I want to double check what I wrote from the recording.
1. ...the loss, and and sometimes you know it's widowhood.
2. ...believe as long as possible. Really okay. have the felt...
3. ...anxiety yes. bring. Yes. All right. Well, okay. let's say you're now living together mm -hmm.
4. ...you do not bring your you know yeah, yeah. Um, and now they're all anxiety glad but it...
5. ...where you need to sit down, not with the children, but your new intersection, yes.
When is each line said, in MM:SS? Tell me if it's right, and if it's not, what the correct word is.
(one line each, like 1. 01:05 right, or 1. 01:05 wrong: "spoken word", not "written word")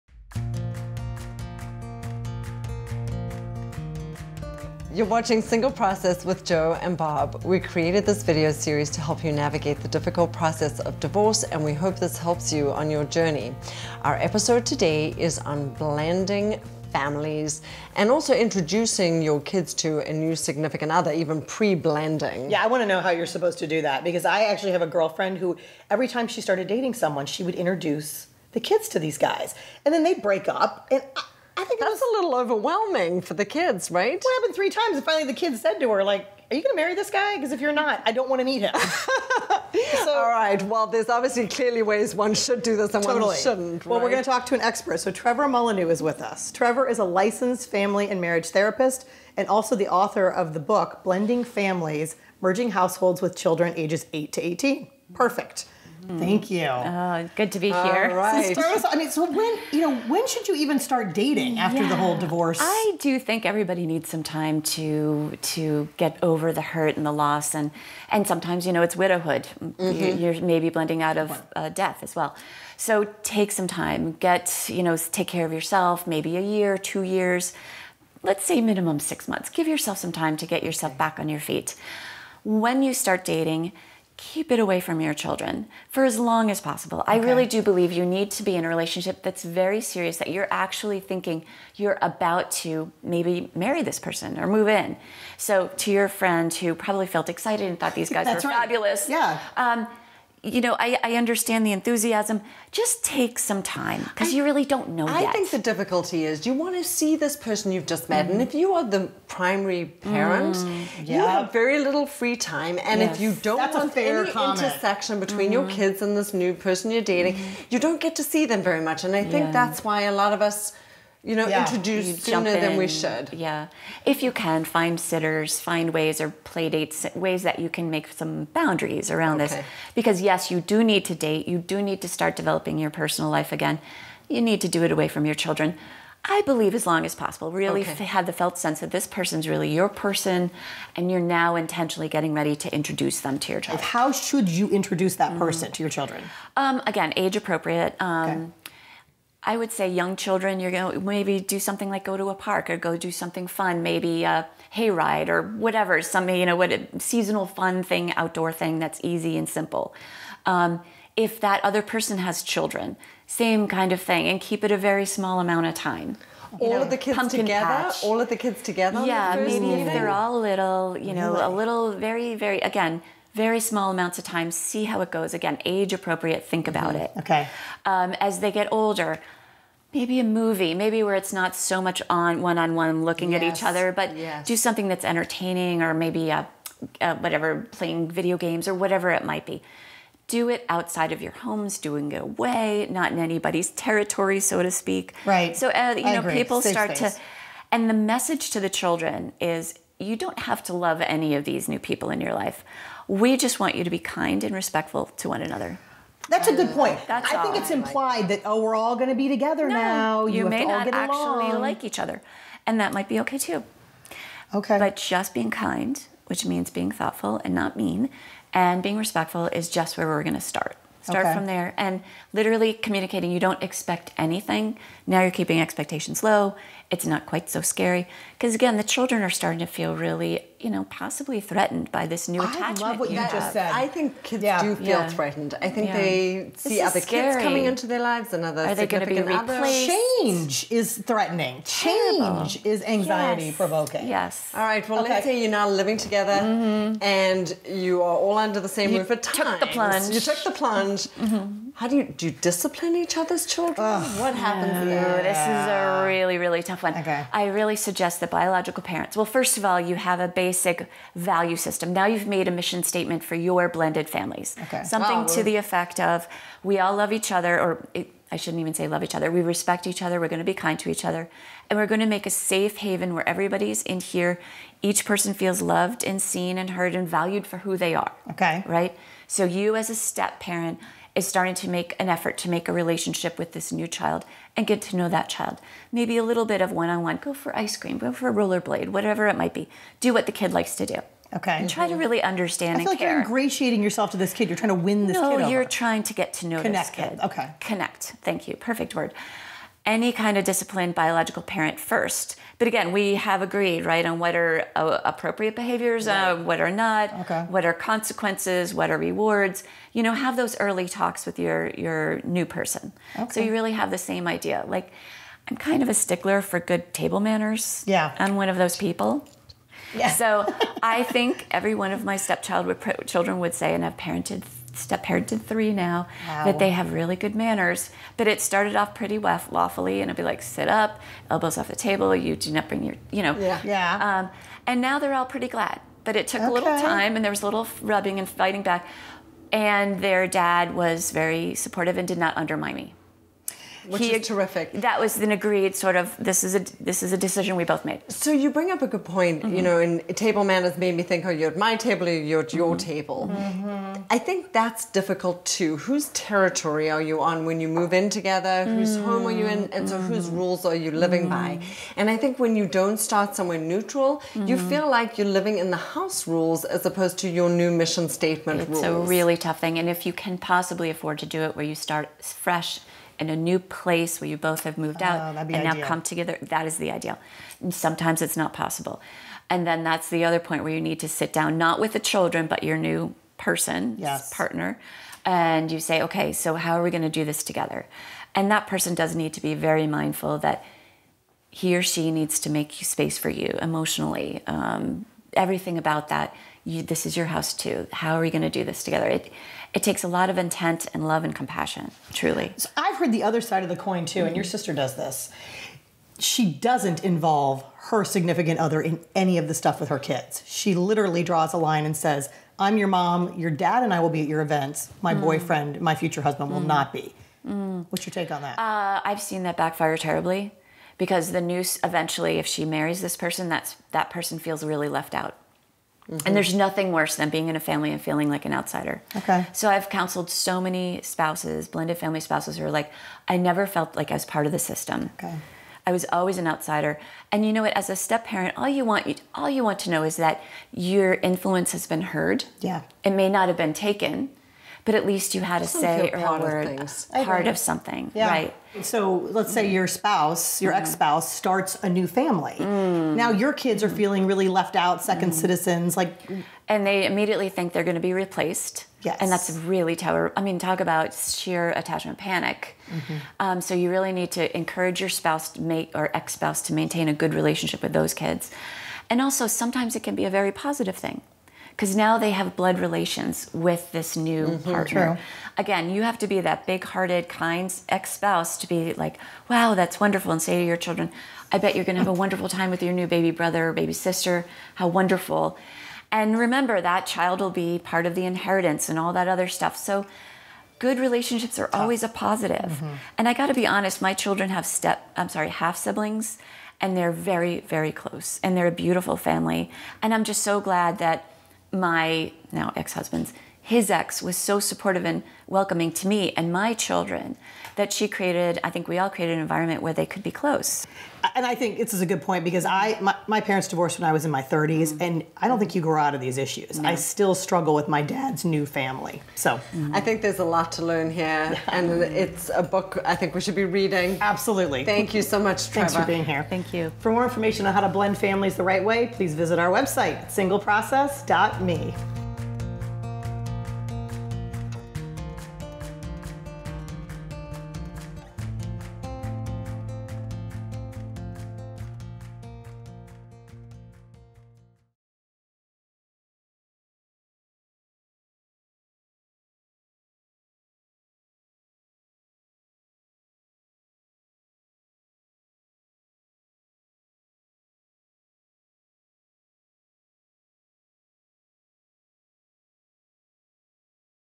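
1. 01:07 right
2. 02:16 right
3. 04:02 wrong: "provoking", not "bring"
4. 05:32 wrong: "pretty", not "anxiety"
5. 06:20 wrong: "person", not "intersection".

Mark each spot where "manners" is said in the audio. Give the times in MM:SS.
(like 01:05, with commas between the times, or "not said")
05:17, 05:27, 05:50.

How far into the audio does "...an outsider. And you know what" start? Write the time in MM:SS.
07:16.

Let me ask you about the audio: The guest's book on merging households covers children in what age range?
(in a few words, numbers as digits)
8 to 18.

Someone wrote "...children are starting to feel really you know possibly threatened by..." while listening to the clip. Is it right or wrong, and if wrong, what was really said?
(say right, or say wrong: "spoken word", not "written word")
right.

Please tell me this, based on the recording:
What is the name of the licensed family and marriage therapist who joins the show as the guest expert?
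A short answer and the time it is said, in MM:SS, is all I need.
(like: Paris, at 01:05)
Trevor Mullineaux, at 00:45.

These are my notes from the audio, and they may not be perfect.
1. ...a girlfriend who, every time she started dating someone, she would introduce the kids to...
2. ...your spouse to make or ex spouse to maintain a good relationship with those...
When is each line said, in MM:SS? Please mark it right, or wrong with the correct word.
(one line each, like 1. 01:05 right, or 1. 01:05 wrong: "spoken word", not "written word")
1. 00:24 right
2. 07:45 right.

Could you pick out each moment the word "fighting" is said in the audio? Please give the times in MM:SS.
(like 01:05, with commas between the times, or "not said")
05:38.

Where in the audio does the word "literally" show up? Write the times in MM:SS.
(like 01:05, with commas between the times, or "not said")
03:42, 06:50.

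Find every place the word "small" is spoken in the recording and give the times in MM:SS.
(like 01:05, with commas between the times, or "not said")
02:45, 02:53.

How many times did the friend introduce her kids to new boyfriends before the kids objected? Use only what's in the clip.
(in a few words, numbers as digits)
3.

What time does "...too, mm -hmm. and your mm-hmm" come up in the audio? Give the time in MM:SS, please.
06:44.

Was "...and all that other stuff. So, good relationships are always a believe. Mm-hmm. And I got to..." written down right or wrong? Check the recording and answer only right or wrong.
wrong.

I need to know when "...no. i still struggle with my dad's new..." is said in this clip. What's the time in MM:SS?
08:36.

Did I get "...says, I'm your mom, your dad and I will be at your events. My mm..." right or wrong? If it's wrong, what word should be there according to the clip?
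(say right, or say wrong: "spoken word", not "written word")
right.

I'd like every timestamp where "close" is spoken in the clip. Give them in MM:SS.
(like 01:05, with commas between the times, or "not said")
08:17, 08:30.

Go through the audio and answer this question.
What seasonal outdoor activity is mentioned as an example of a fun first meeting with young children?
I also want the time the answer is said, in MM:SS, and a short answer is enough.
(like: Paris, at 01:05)
hayride, at 02:34.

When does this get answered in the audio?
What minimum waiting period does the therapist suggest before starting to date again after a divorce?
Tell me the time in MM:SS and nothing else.
01:18.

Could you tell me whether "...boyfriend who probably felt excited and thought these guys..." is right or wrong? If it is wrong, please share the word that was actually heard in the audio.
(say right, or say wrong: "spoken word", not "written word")
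wrong: "friend", not "boyfriend".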